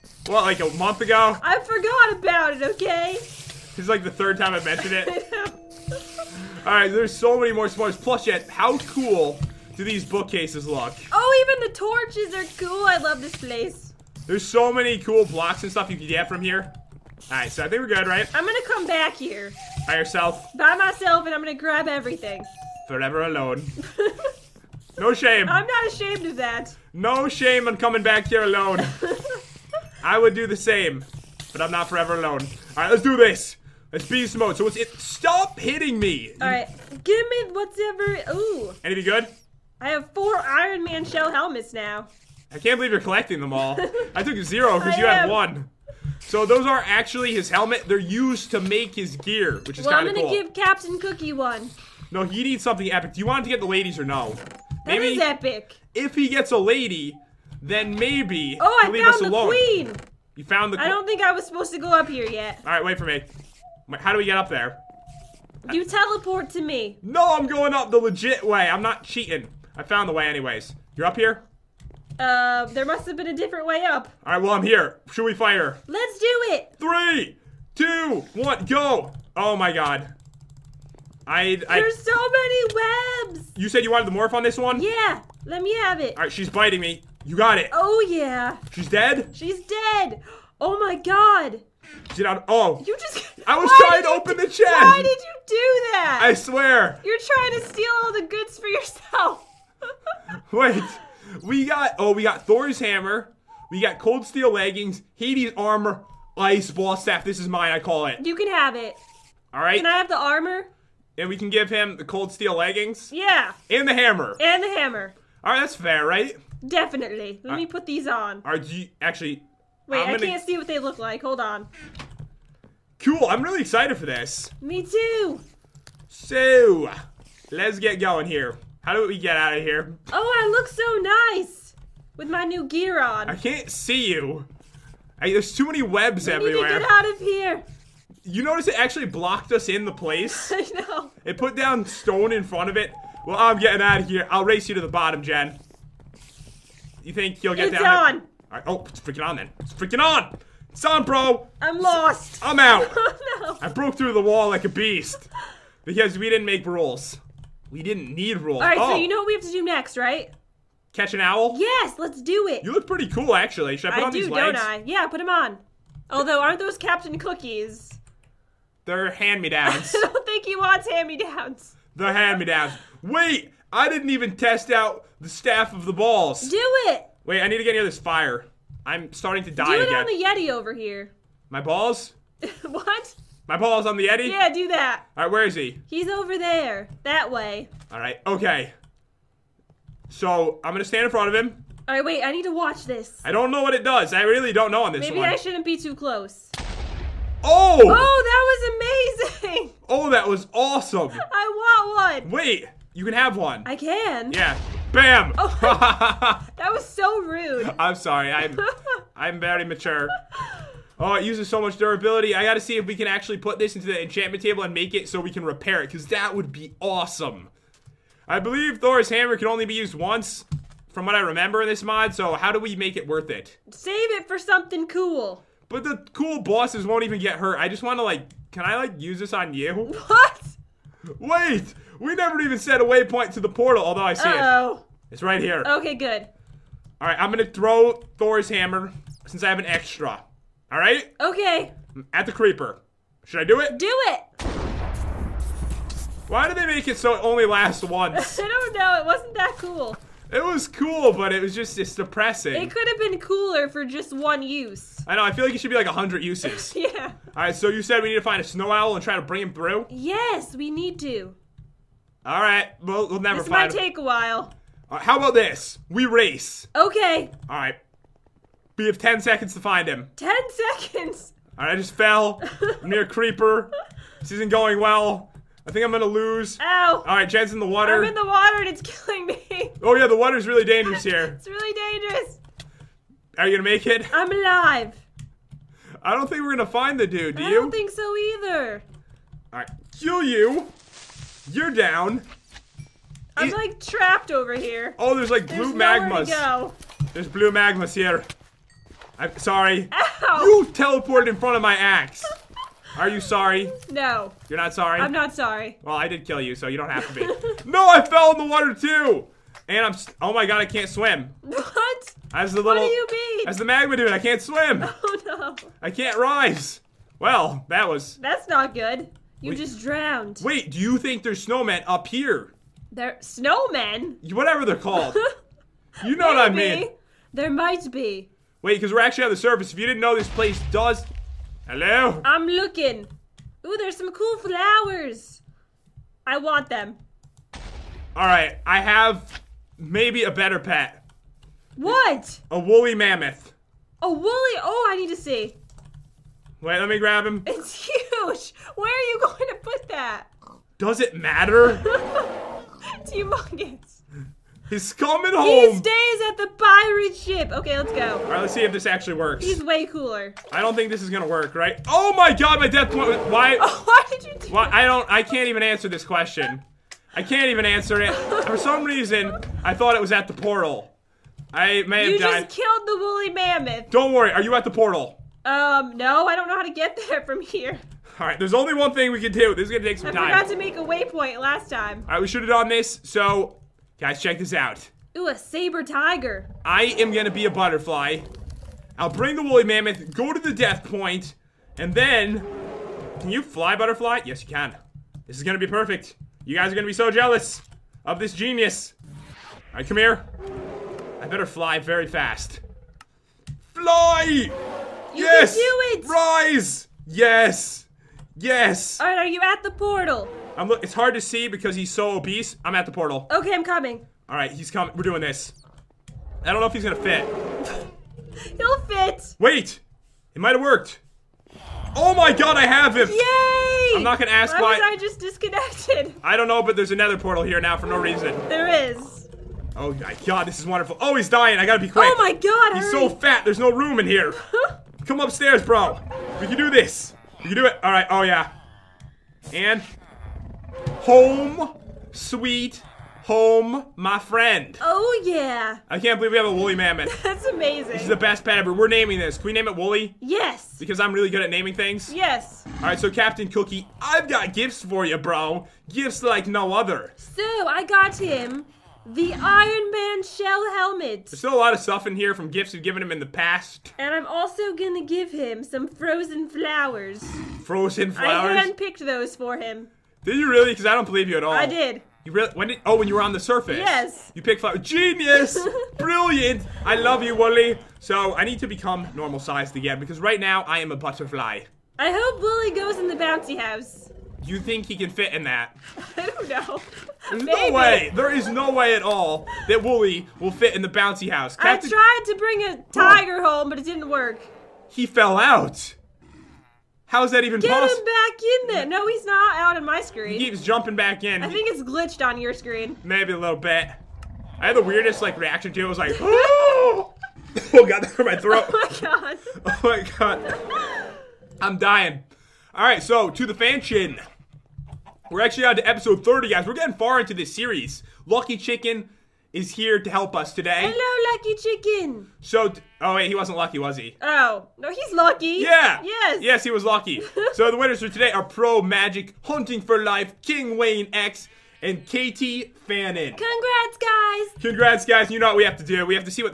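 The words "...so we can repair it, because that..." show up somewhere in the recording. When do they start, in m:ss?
3:35.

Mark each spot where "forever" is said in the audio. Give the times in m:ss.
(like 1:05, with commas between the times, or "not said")
0:22, 0:31.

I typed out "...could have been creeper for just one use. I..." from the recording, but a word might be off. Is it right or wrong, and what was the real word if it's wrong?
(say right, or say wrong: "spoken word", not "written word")
wrong: "cooler", not "creeper".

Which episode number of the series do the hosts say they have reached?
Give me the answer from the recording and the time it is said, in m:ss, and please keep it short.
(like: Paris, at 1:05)
30, at 8:35.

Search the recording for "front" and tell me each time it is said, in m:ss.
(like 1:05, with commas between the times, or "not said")
2:22, 3:11, 5:01.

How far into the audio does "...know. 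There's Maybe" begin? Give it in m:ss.
8:06.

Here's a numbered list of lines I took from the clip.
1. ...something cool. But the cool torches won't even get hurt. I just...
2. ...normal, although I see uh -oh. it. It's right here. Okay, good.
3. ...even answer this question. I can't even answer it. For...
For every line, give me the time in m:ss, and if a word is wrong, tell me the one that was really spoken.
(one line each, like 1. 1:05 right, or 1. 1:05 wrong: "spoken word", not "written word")
1. 3:44 wrong: "bosses", not "torches"
2. 3:53 wrong: "portal", not "normal"
3. 6:05 right.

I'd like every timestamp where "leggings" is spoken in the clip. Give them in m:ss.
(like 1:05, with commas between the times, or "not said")
1:44, 1:52.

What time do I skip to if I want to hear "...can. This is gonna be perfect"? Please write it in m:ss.
6:34.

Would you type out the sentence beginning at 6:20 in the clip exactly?
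I forgot to make a waypoint last time.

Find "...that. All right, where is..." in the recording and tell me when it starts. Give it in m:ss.
3:04.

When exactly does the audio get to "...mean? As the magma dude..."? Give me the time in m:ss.
5:13.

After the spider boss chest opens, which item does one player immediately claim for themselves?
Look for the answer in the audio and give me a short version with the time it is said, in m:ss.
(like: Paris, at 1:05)
ice ball staff, at 1:46.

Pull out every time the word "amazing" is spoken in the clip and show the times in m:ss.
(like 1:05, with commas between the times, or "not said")
3:19, 7:27.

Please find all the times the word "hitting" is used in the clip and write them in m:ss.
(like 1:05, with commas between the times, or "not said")
0:35.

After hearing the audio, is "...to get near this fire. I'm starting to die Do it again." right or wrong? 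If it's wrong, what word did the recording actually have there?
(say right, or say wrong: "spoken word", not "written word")
right.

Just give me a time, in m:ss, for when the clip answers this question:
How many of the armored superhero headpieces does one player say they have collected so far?
0:40.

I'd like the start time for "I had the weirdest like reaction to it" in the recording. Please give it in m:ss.
8:24.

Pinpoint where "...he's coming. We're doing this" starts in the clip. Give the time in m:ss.
6:54.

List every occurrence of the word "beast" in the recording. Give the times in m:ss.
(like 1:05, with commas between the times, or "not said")
0:34, 2:34.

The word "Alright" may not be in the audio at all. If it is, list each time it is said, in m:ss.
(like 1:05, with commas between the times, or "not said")
4:37, 4:49, 6:39, 6:48.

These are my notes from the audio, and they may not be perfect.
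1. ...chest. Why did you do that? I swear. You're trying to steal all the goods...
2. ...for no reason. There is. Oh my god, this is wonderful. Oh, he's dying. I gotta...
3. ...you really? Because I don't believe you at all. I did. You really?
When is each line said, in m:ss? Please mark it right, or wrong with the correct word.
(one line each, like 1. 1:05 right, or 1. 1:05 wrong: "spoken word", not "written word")
1. 1:34 right
2. 7:07 right
3. 7:50 right.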